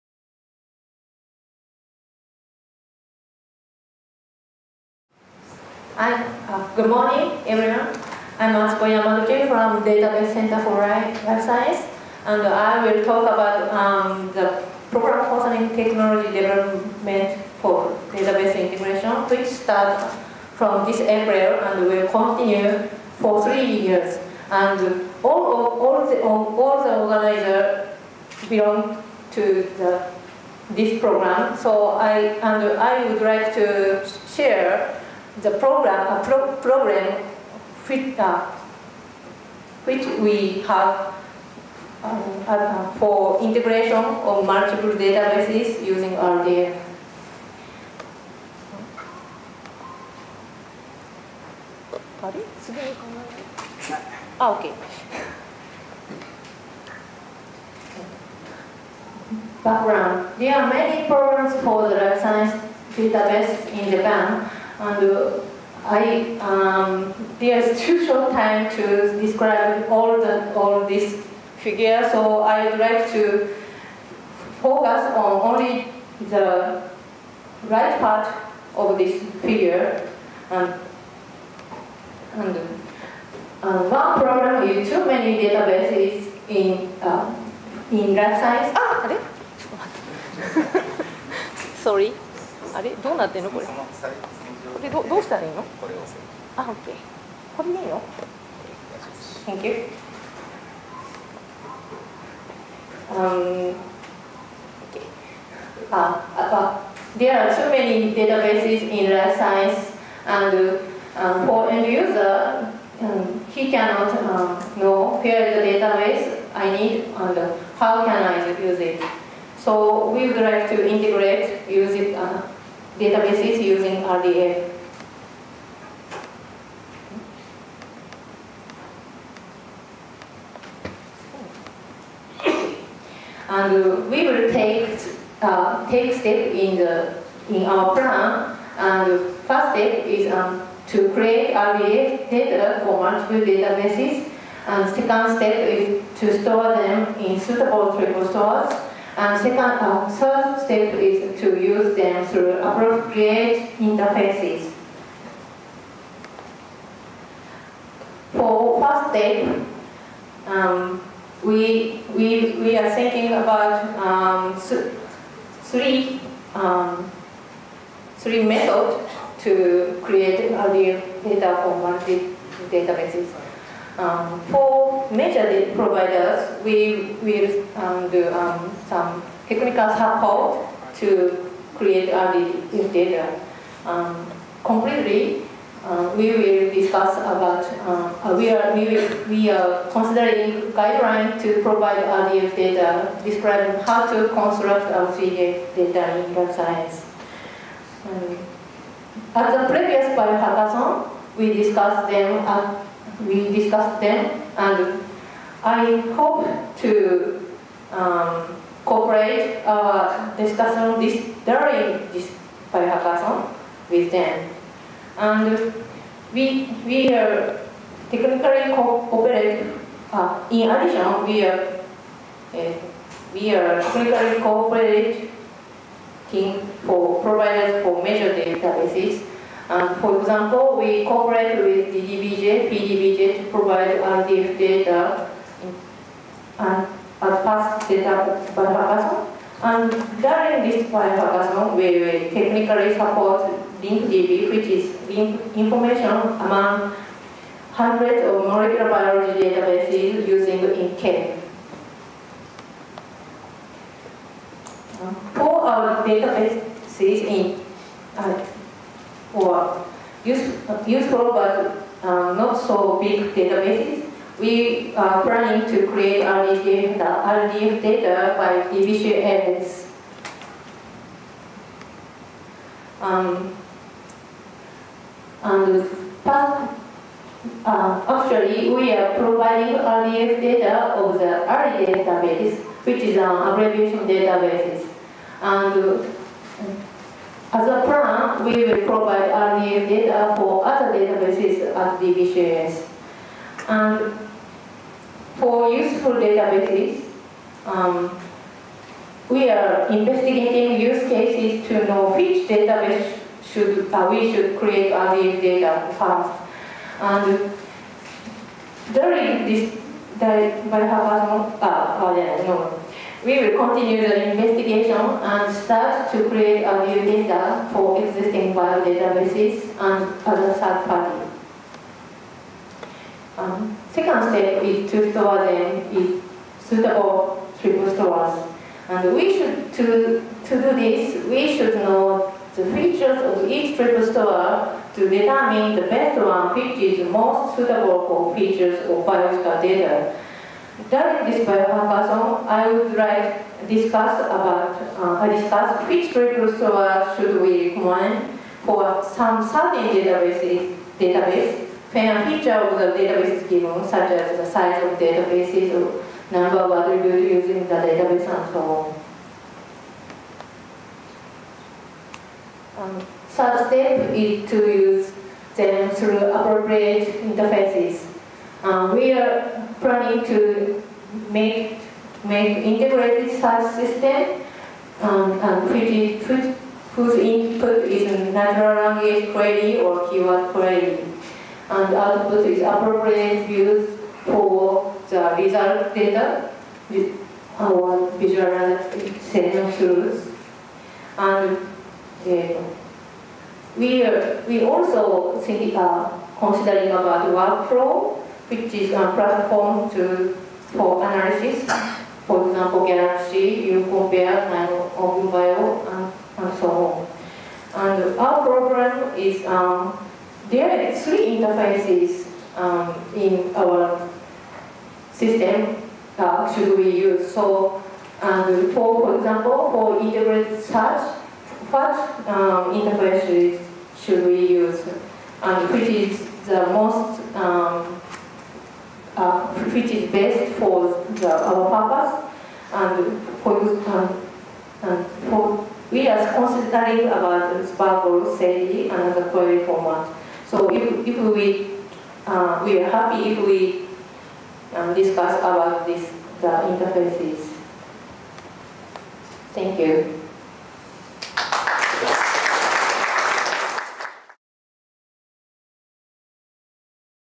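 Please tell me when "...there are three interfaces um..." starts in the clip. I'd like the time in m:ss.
6:50.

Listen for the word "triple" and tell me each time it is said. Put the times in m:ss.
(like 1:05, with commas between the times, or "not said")
2:27, 5:27, 5:33.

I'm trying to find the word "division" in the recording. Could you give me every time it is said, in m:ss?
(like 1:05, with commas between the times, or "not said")
4:28.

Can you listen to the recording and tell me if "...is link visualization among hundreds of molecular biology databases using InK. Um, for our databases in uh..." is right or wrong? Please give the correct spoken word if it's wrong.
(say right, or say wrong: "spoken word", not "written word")
wrong: "information", not "visualization".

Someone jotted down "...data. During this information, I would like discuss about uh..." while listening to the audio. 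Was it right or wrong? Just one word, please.
wrong.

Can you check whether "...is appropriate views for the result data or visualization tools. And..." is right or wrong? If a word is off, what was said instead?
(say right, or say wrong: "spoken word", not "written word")
right.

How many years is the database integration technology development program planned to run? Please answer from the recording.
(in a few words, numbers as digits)
3.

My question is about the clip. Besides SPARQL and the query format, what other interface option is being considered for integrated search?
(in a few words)
SADI.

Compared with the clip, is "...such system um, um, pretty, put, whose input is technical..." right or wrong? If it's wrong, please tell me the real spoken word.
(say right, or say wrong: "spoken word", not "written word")
wrong: "natural", not "technical".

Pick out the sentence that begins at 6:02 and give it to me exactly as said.
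Um, third step is to use them through appropriate interfaces.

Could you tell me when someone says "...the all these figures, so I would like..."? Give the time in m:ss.
1:10.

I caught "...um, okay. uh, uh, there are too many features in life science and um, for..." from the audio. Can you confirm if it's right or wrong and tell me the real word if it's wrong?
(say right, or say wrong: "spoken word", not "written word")
wrong: "databases", not "features".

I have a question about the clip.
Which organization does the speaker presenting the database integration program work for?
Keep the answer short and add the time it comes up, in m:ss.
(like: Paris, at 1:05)
Database Center for Life Science, at 0:09.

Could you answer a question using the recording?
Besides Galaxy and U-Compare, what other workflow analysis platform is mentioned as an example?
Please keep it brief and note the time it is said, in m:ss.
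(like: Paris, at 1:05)
OpenBio, at 6:44.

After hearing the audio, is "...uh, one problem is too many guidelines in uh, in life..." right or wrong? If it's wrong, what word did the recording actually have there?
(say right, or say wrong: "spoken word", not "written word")
wrong: "databases", not "guidelines".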